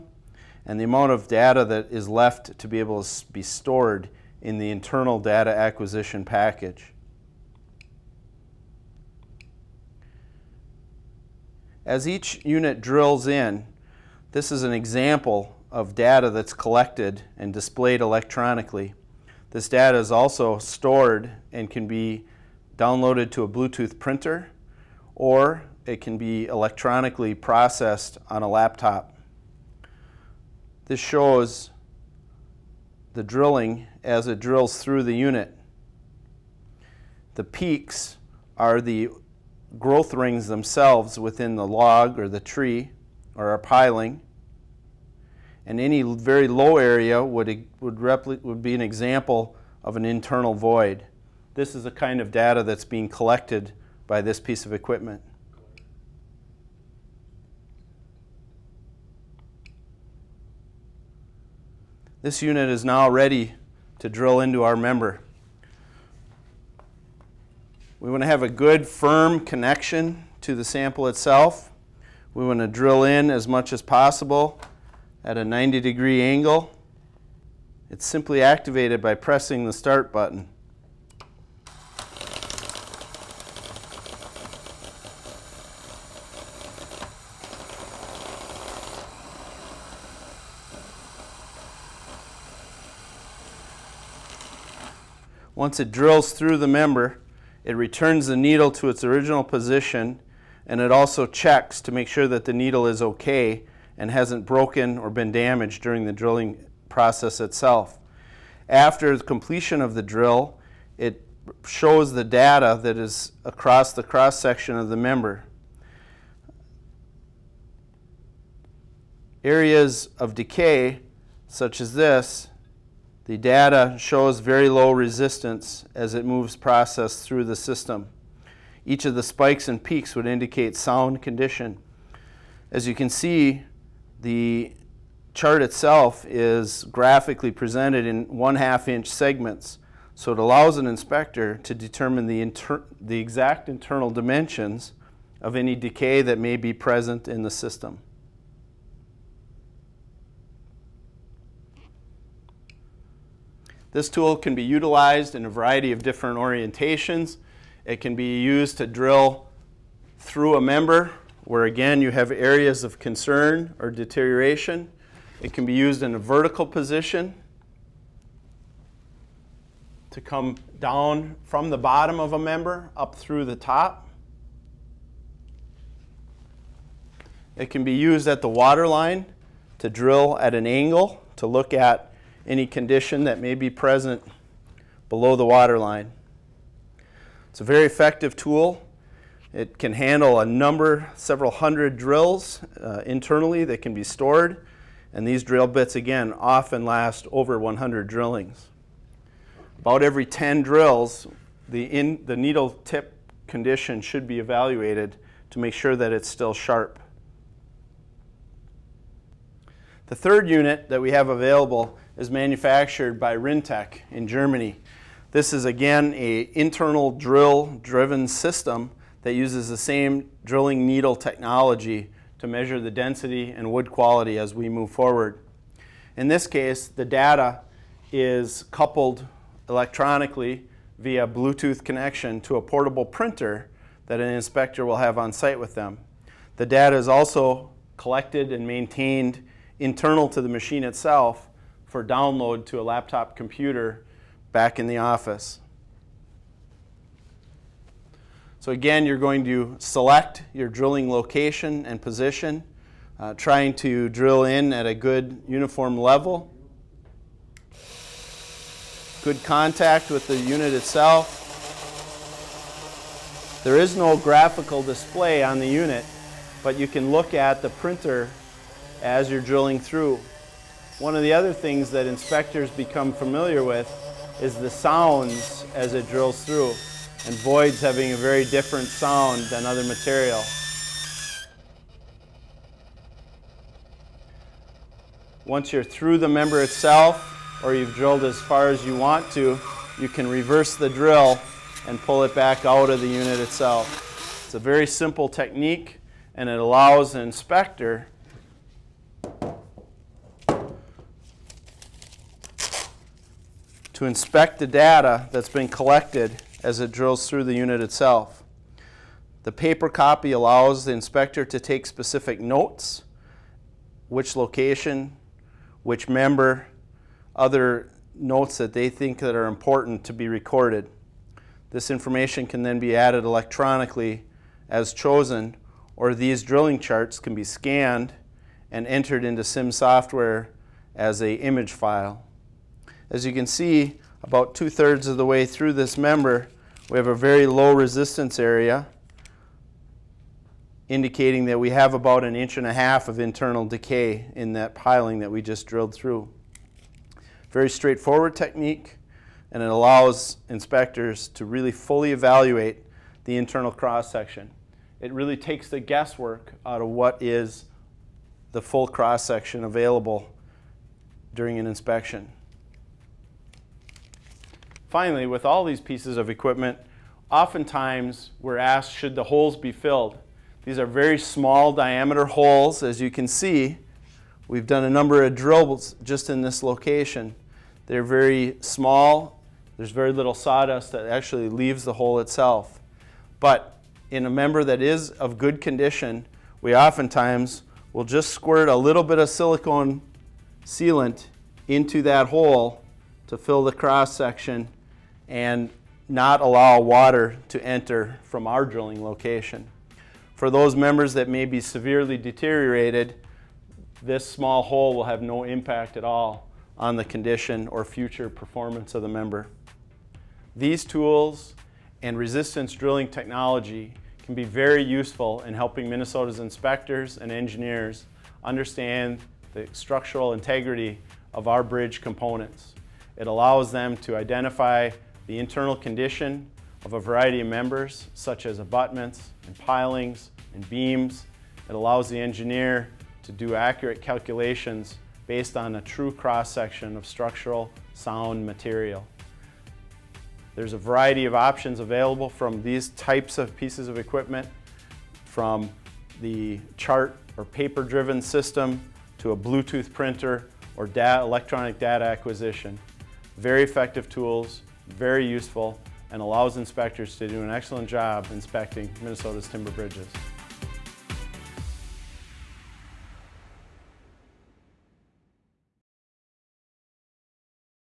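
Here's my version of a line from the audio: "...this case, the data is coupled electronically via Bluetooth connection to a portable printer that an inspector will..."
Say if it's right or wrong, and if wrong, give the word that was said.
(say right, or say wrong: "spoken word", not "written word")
right.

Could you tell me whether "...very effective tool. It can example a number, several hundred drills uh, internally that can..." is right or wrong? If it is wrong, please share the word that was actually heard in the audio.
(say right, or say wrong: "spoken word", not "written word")
wrong: "handle", not "example".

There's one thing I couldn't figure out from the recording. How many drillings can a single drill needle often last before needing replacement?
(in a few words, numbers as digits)
Over 100.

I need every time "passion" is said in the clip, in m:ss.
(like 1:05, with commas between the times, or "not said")
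not said.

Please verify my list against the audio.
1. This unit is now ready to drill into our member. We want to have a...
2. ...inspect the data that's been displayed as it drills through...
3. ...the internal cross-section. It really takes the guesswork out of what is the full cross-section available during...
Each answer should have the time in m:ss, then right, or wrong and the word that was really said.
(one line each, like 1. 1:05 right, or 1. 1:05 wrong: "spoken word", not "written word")
1. 1:02 right
2. 5:04 wrong: "collected", not "displayed"
3. 5:53 right.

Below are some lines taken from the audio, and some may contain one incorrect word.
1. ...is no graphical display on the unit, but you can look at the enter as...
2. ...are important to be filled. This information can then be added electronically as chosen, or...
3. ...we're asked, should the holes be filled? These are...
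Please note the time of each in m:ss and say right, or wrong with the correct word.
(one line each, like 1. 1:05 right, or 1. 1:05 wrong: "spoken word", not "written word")
1. 4:23 wrong: "printer", not "enter"
2. 5:19 wrong: "recorded", not "filled"
3. 6:08 right.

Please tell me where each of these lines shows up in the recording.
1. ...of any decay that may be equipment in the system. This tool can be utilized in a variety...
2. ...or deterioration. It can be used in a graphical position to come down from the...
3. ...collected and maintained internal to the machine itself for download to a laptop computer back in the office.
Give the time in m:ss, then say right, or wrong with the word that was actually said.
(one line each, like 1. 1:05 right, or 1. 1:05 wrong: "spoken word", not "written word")
1. 2:25 wrong: "present", not "equipment"
2. 2:43 wrong: "vertical", not "graphical"
3. 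3:57 right.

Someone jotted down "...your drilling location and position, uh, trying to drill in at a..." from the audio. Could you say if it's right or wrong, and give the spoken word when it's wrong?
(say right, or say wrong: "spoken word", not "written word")
right.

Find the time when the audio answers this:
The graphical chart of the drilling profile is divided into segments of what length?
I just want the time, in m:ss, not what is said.
2:18.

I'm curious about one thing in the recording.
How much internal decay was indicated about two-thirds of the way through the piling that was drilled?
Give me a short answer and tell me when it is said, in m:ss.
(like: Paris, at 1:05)
An inch and a half, at 5:42.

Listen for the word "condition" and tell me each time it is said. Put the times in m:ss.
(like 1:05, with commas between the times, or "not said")
2:11, 3:02, 3:23, 6:25, 6:47, 7:05.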